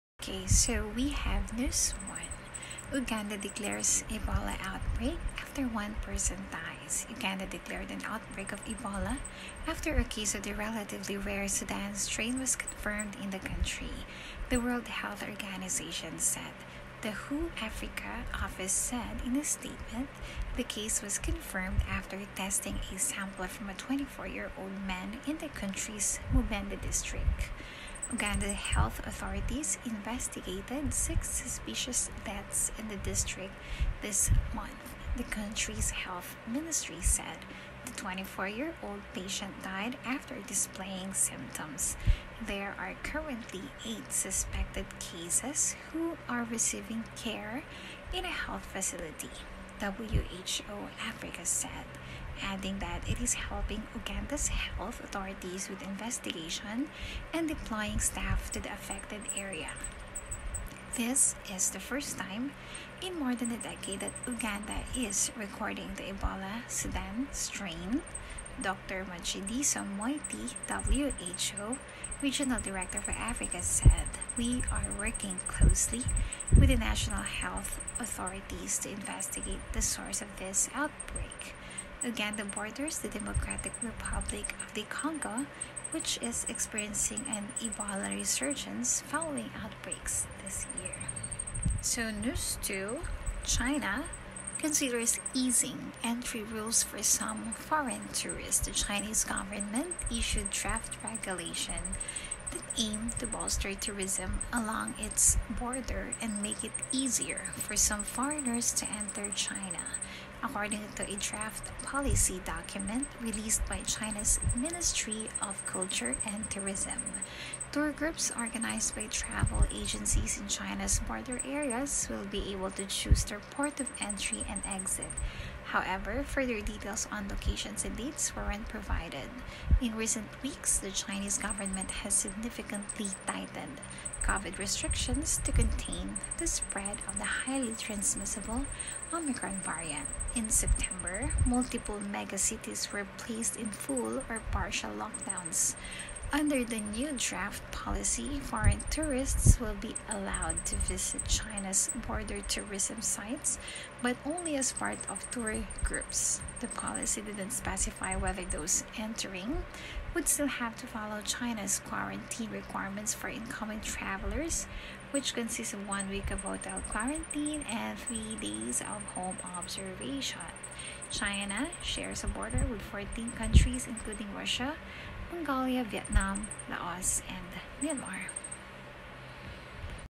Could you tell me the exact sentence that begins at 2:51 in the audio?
China shares a border with 14 countries, including Russia, Mongolia, Vietnam, Laos, and Myanmar.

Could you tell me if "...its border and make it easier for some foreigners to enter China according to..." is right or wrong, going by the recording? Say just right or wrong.
right.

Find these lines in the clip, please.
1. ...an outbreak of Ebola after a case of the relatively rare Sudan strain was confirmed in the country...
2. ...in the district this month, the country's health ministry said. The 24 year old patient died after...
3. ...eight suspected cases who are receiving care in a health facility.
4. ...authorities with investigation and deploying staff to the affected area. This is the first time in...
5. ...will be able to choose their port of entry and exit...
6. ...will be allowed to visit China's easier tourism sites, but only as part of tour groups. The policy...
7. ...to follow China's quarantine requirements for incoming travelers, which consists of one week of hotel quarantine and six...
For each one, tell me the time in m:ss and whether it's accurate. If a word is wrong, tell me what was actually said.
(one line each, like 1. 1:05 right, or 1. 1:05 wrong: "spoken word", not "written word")
1. 0:07 right
2. 0:32 right
3. 0:43 right
4. 0:55 right
5. 2:02 right
6. 2:29 wrong: "border", not "easier"
7. 2:40 wrong: "three", not "six".